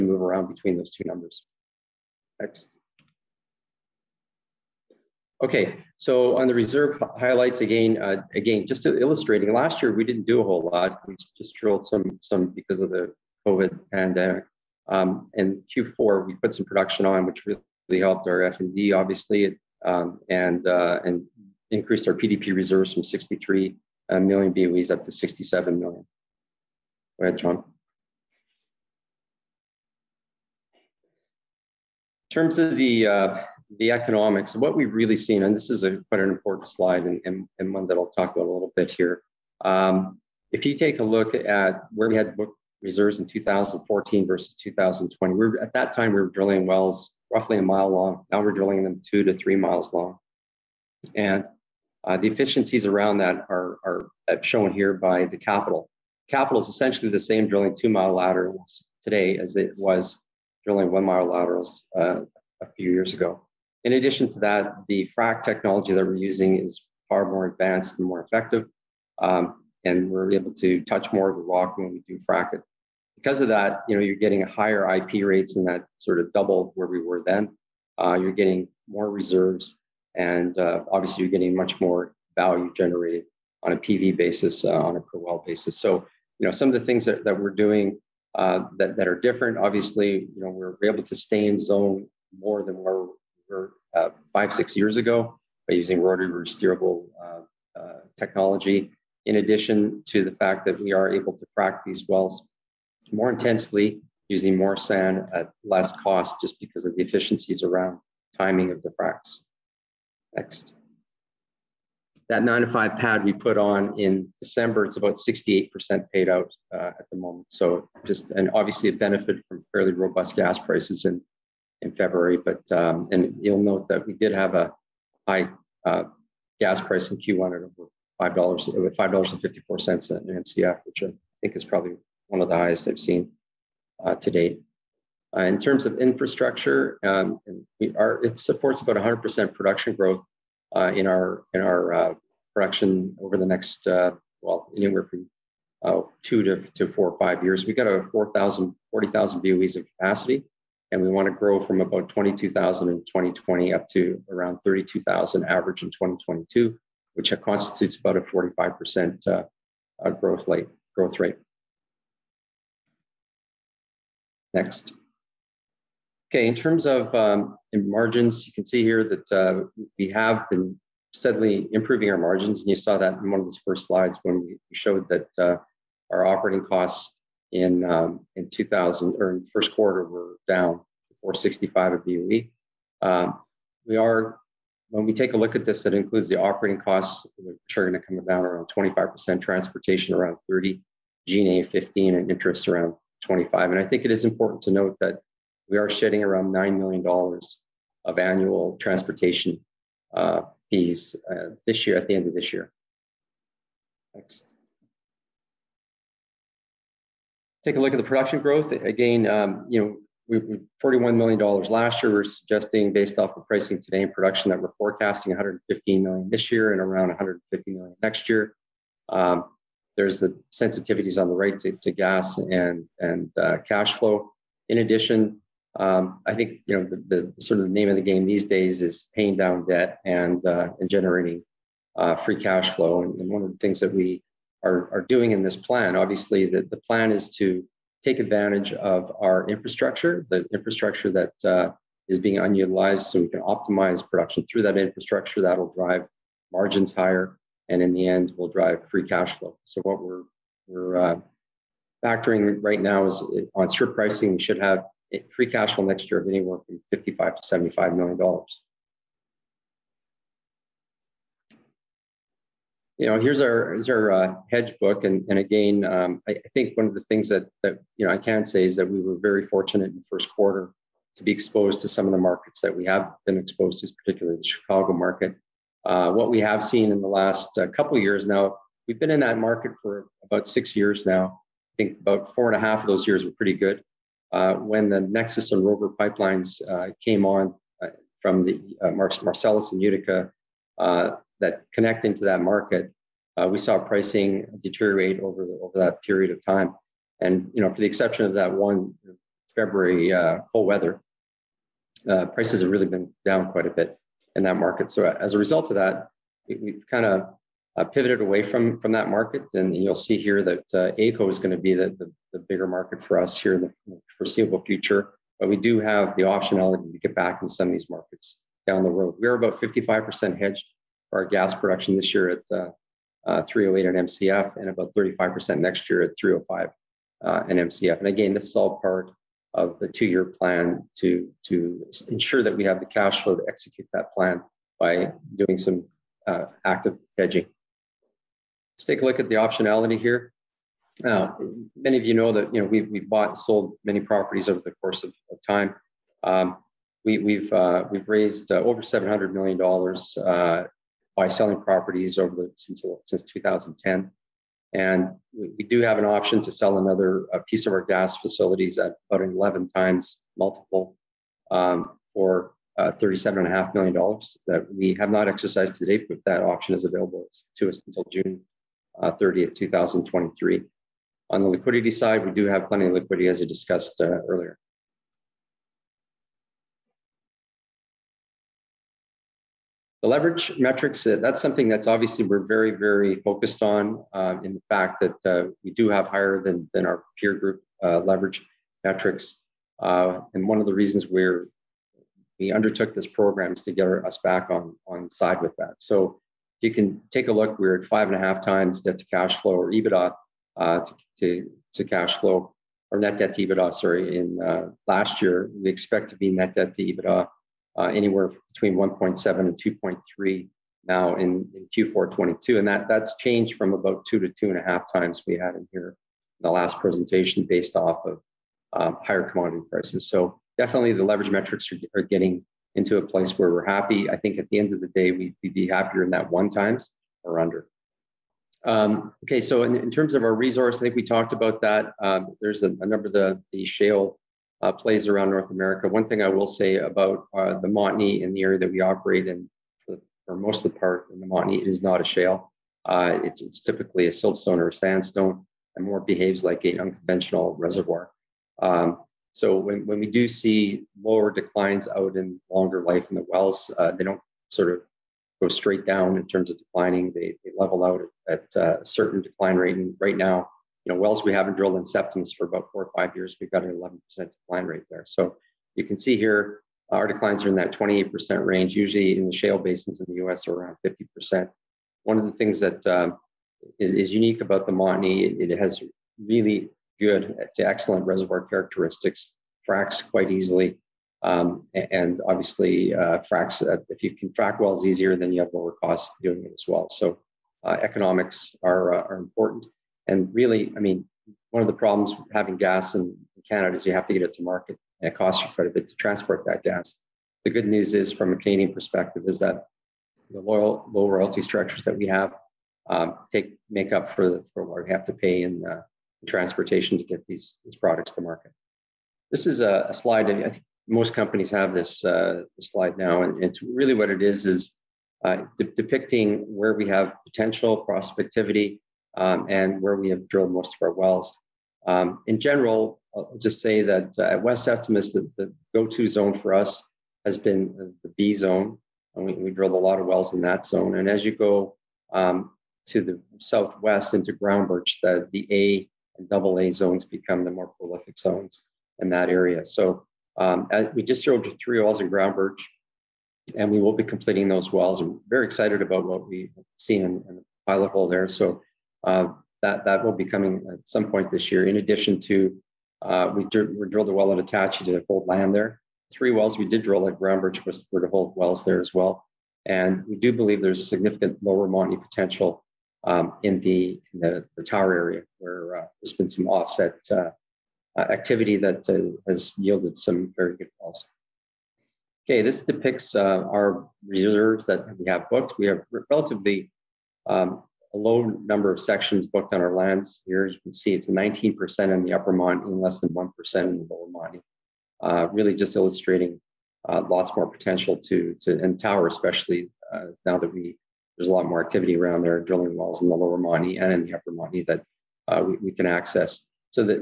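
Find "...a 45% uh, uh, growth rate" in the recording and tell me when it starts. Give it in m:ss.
2:38.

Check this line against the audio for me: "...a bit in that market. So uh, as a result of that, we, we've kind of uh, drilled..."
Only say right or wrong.
wrong.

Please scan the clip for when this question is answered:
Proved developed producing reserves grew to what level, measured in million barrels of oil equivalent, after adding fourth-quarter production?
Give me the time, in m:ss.
0:25.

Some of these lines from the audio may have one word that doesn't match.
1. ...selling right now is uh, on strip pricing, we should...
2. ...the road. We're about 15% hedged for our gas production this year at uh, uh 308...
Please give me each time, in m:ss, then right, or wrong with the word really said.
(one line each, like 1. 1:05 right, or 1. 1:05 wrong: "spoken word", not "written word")
1. 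4:12 wrong: "factoring", not "selling"
2. 5:18 wrong: "55", not "15".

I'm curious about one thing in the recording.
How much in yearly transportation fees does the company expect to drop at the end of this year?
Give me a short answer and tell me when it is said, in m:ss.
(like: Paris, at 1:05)
$9 million, at 3:16.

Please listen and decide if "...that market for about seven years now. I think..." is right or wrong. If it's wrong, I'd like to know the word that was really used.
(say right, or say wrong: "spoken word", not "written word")
wrong: "six", not "seven".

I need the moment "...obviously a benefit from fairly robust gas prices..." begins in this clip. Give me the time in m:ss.
1:58.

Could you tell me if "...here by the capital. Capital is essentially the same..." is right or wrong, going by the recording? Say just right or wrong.
right.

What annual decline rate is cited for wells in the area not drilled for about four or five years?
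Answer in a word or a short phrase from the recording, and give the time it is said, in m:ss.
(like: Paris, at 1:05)
11%, at 7:43.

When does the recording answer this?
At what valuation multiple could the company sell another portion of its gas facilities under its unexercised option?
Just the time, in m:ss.
5:59.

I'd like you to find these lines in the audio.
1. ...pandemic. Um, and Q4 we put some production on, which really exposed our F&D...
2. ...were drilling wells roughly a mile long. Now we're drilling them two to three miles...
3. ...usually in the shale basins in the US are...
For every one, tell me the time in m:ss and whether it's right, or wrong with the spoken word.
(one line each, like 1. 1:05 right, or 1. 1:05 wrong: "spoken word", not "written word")
1. 0:13 wrong: "helped", not "exposed"
2. 0:46 right
3. 7:48 right.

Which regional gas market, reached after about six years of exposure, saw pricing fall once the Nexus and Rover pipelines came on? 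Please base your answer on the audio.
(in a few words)
Chicago.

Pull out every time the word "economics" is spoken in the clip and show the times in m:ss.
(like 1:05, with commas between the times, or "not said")
0:33, 8:07.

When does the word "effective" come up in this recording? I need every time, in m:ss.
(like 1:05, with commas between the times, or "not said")
1:08.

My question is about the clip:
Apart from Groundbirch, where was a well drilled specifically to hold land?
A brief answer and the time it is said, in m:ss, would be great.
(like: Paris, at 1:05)
Attachie, at 9:14.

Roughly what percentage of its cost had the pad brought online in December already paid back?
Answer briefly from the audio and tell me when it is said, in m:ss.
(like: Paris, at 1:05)
68%, at 1:55.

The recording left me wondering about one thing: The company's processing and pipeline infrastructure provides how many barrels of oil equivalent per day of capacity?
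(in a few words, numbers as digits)
40,000.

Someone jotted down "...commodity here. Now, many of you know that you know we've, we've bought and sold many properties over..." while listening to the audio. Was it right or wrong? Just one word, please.
wrong.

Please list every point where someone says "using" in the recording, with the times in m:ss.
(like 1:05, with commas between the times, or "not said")
1:06, 1:35, 1:44.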